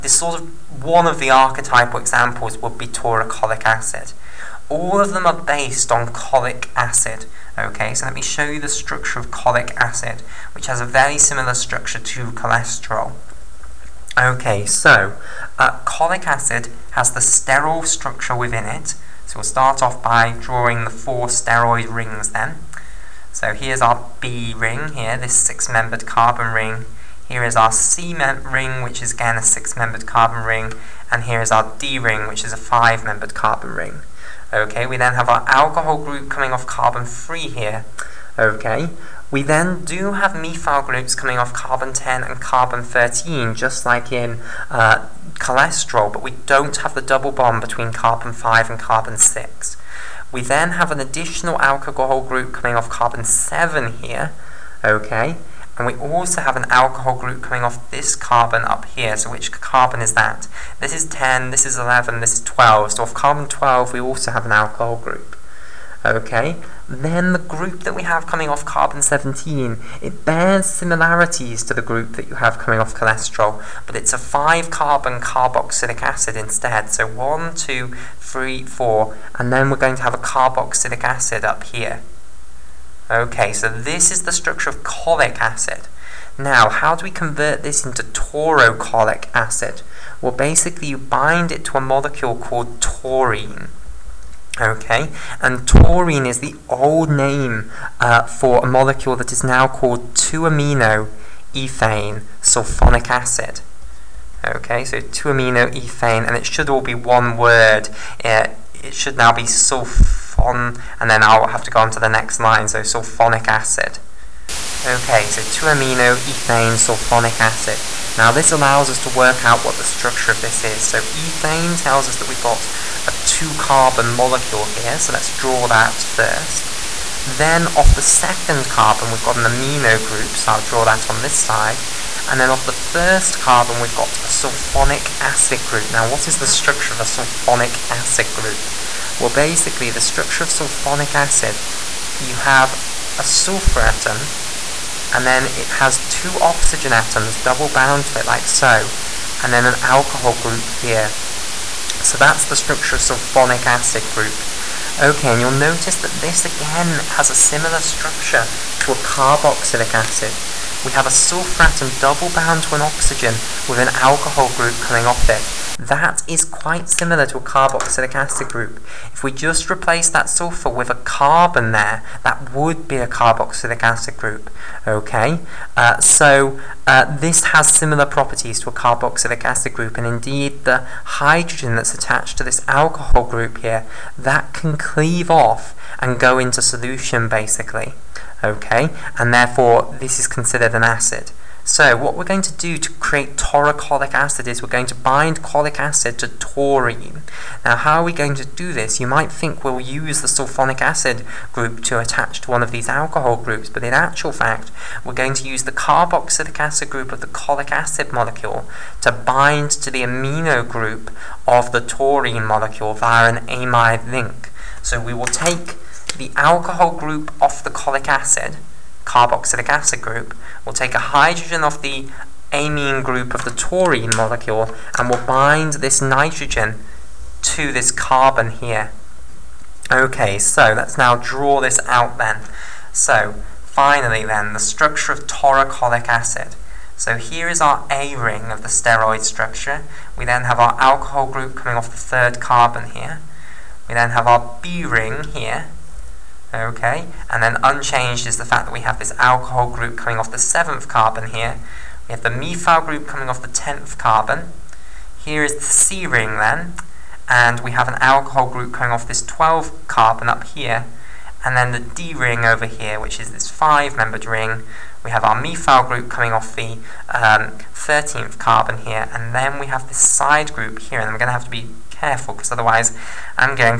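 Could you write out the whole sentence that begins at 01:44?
Okay, so 2-amino ethane, and it should all be one word.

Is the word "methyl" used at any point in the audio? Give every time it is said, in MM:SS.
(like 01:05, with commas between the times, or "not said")
00:40, 04:12, 04:25.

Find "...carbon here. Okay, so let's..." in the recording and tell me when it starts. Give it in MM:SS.
03:47.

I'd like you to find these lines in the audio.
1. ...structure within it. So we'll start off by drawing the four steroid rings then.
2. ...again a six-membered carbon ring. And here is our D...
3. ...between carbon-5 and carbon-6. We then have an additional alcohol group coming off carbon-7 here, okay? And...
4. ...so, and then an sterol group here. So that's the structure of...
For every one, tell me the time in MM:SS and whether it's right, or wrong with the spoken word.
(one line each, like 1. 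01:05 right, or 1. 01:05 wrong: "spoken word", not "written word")
1. 00:17 right
2. 00:29 right
3. 00:47 right
4. 02:28 wrong: "alcohol", not "sterol".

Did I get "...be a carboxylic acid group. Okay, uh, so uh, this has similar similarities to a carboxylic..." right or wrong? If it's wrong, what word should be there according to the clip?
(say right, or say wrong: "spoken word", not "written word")
wrong: "properties", not "similarities".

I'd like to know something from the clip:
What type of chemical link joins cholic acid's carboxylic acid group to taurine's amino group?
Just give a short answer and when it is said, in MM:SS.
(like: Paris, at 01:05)
amide link, at 03:33.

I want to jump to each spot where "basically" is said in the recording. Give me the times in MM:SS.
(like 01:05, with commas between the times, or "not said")
01:30, 02:19, 03:07.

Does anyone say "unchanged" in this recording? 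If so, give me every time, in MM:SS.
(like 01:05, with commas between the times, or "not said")
04:07.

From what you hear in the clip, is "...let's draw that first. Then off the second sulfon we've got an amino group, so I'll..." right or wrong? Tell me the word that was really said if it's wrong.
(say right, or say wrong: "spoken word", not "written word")
wrong: "carbon", not "sulfon".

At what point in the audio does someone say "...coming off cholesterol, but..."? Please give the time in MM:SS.
01:12.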